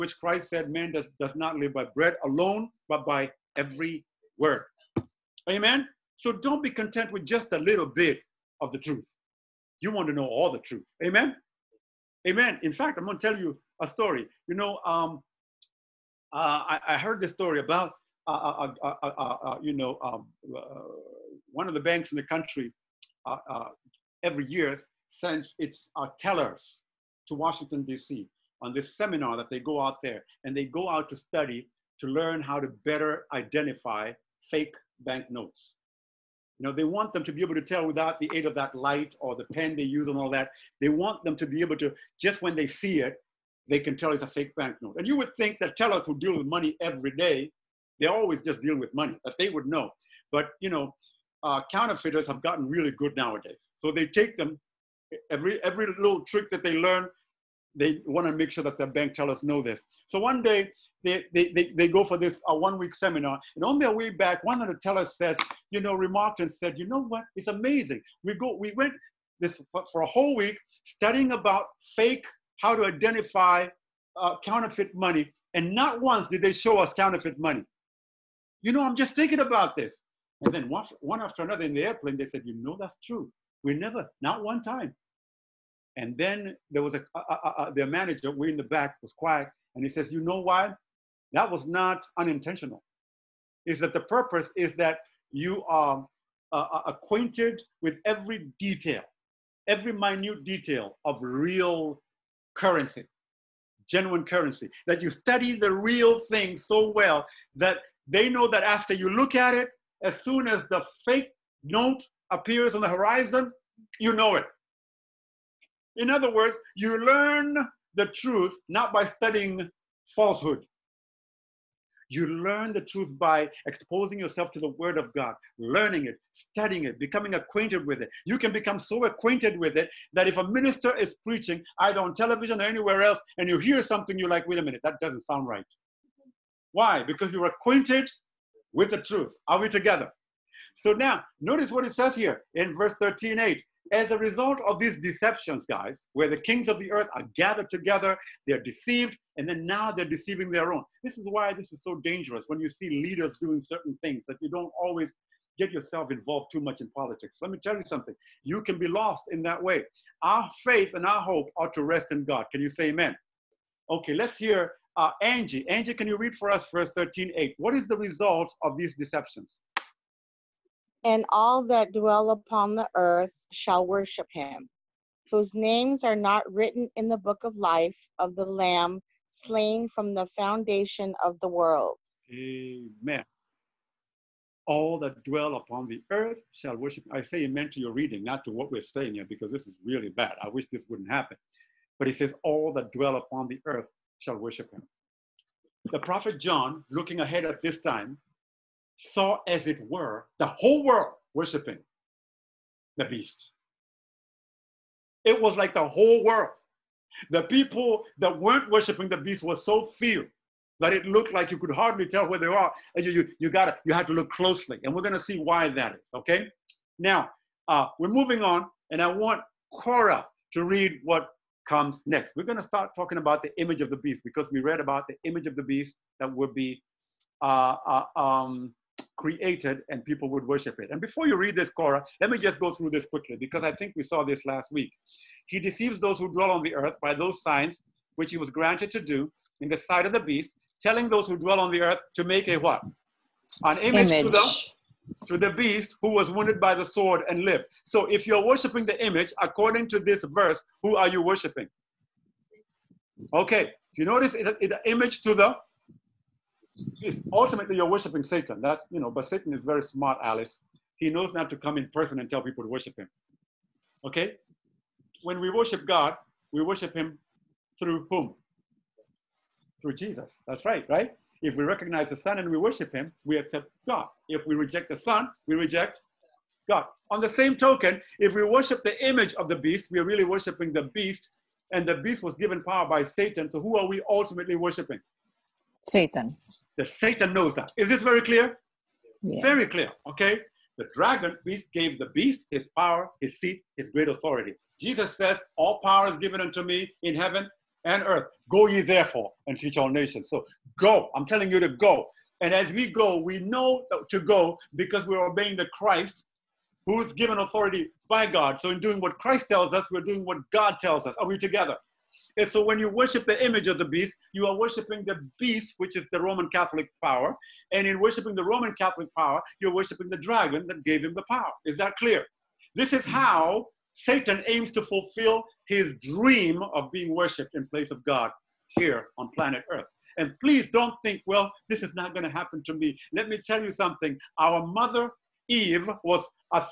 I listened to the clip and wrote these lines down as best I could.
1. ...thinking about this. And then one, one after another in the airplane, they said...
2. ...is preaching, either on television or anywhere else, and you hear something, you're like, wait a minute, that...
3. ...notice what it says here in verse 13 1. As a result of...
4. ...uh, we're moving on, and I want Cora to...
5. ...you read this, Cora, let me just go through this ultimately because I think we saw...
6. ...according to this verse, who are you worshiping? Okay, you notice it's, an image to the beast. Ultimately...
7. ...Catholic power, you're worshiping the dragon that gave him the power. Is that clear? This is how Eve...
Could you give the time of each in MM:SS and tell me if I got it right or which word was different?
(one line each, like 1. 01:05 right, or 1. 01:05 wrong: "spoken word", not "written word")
1. 01:19 right
2. 02:10 right
3. 02:21 wrong: "8", not "1"
4. 03:37 right
5. 03:51 wrong: "quickly", not "ultimately"
6. 04:09 right
7. 05:18 wrong: "Satan", not "Eve".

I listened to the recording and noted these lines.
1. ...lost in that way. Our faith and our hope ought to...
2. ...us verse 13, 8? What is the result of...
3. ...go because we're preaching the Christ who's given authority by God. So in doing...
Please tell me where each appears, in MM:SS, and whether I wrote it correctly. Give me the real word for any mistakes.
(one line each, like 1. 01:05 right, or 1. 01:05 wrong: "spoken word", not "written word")
1. 02:38 right
2. 02:46 right
3. 05:04 wrong: "obeying", not "preaching".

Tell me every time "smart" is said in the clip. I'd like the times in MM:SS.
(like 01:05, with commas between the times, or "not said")
04:19.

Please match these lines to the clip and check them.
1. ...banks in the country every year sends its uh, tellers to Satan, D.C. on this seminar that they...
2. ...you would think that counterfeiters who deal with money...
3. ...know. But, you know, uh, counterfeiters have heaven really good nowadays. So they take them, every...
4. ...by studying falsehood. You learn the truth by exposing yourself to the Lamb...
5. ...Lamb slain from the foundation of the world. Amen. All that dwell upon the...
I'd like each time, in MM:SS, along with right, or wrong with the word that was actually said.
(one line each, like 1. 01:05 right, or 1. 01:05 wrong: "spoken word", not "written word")
1. 00:21 wrong: "Washington", not "Satan"
2. 00:45 wrong: "tellers", not "counterfeiters"
3. 00:49 wrong: "gotten", not "heaven"
4. 01:58 wrong: "Word", not "Lamb"
5. 02:58 right.